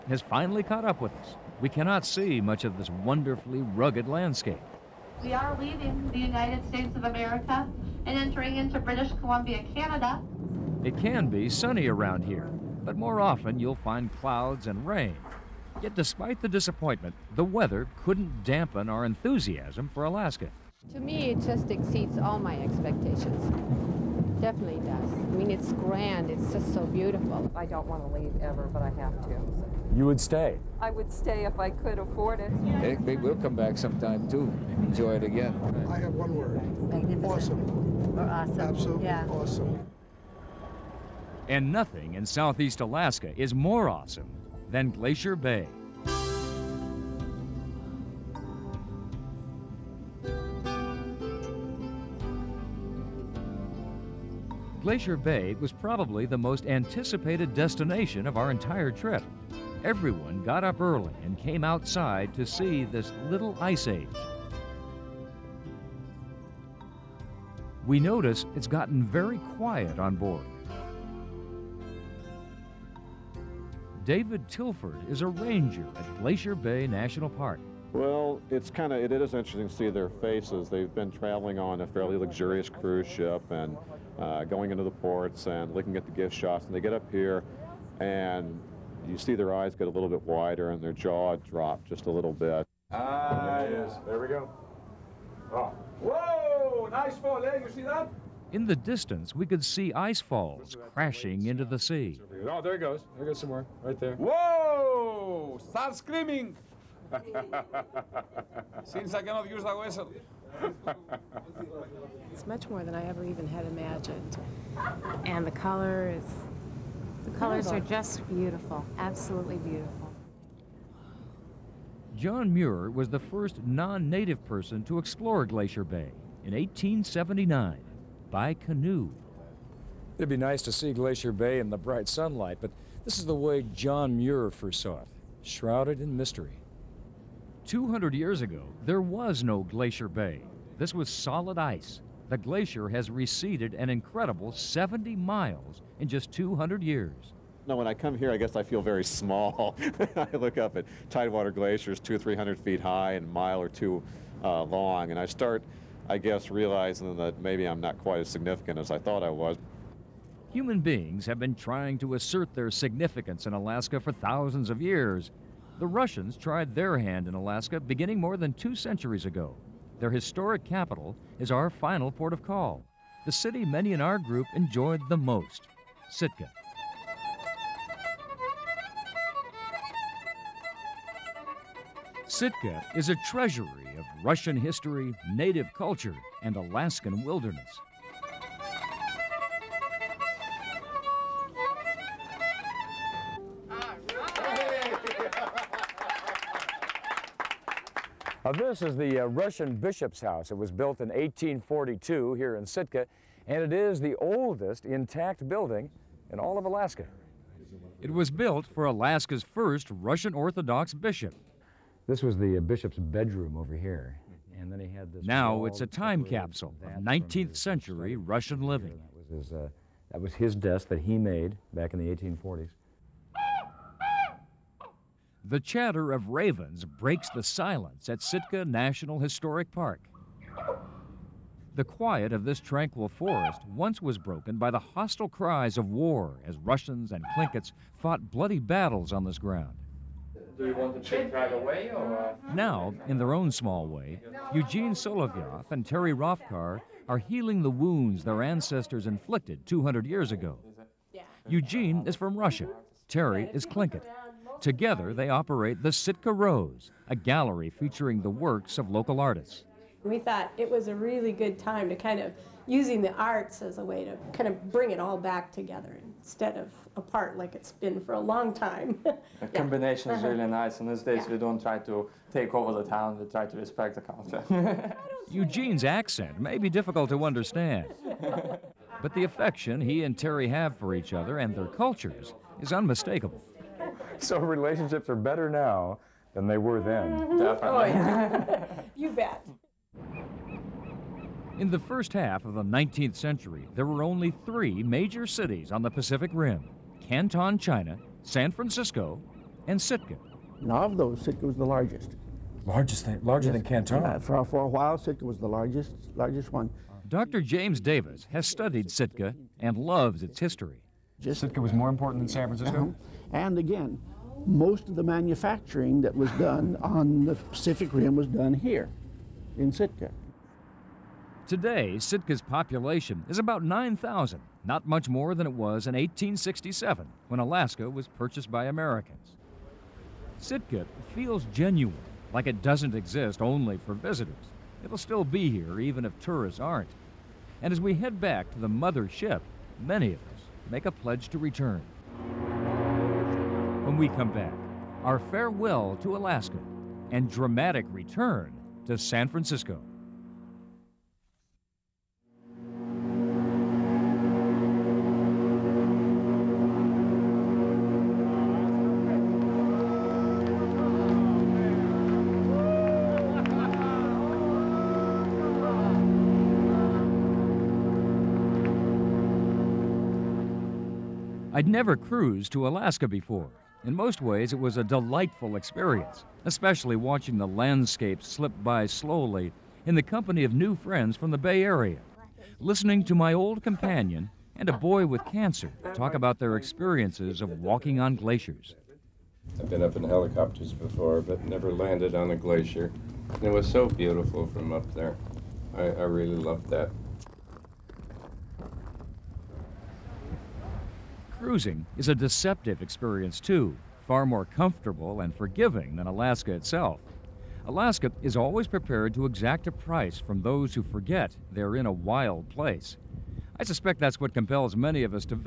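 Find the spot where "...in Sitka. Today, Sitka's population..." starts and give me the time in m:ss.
5:19.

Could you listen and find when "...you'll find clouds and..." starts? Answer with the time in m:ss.
0:13.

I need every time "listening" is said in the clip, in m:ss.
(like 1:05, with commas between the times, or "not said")
6:22.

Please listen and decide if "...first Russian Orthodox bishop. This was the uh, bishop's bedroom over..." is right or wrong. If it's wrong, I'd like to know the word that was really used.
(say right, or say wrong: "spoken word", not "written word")
right.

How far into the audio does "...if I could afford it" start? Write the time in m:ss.
0:31.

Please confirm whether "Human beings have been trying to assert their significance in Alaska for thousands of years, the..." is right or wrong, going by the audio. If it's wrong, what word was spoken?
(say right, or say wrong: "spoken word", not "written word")
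right.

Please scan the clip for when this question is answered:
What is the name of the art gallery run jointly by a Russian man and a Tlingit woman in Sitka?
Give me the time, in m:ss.
4:15.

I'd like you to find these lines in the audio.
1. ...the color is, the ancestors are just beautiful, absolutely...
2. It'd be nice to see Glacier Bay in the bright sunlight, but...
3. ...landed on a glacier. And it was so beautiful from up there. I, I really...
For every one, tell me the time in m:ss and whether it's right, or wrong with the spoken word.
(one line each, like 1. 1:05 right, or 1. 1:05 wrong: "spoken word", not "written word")
1. 1:55 wrong: "colors", not "ancestors"
2. 2:10 right
3. 6:31 right.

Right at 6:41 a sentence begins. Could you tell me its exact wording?
Cruising is a deceptive experience, too, far more comfortable and forgiving than Alaska itself.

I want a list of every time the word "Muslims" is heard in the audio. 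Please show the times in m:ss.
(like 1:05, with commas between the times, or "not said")
not said.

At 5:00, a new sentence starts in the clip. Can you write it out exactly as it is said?
Now of those, Sitka was the largest.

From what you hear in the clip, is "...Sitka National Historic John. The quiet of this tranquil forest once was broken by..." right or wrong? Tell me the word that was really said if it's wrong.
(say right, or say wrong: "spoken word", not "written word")
wrong: "Park", not "John".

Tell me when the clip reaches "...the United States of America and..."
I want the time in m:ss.
0:06.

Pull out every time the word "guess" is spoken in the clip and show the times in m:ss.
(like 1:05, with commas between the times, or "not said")
2:28, 2:36.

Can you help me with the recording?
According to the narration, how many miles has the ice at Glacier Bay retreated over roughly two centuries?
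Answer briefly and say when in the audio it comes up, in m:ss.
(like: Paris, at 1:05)
70 miles, at 2:24.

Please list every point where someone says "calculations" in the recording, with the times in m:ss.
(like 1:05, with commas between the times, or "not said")
not said.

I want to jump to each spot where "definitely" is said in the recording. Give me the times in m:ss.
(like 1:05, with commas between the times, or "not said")
0:24, 4:47.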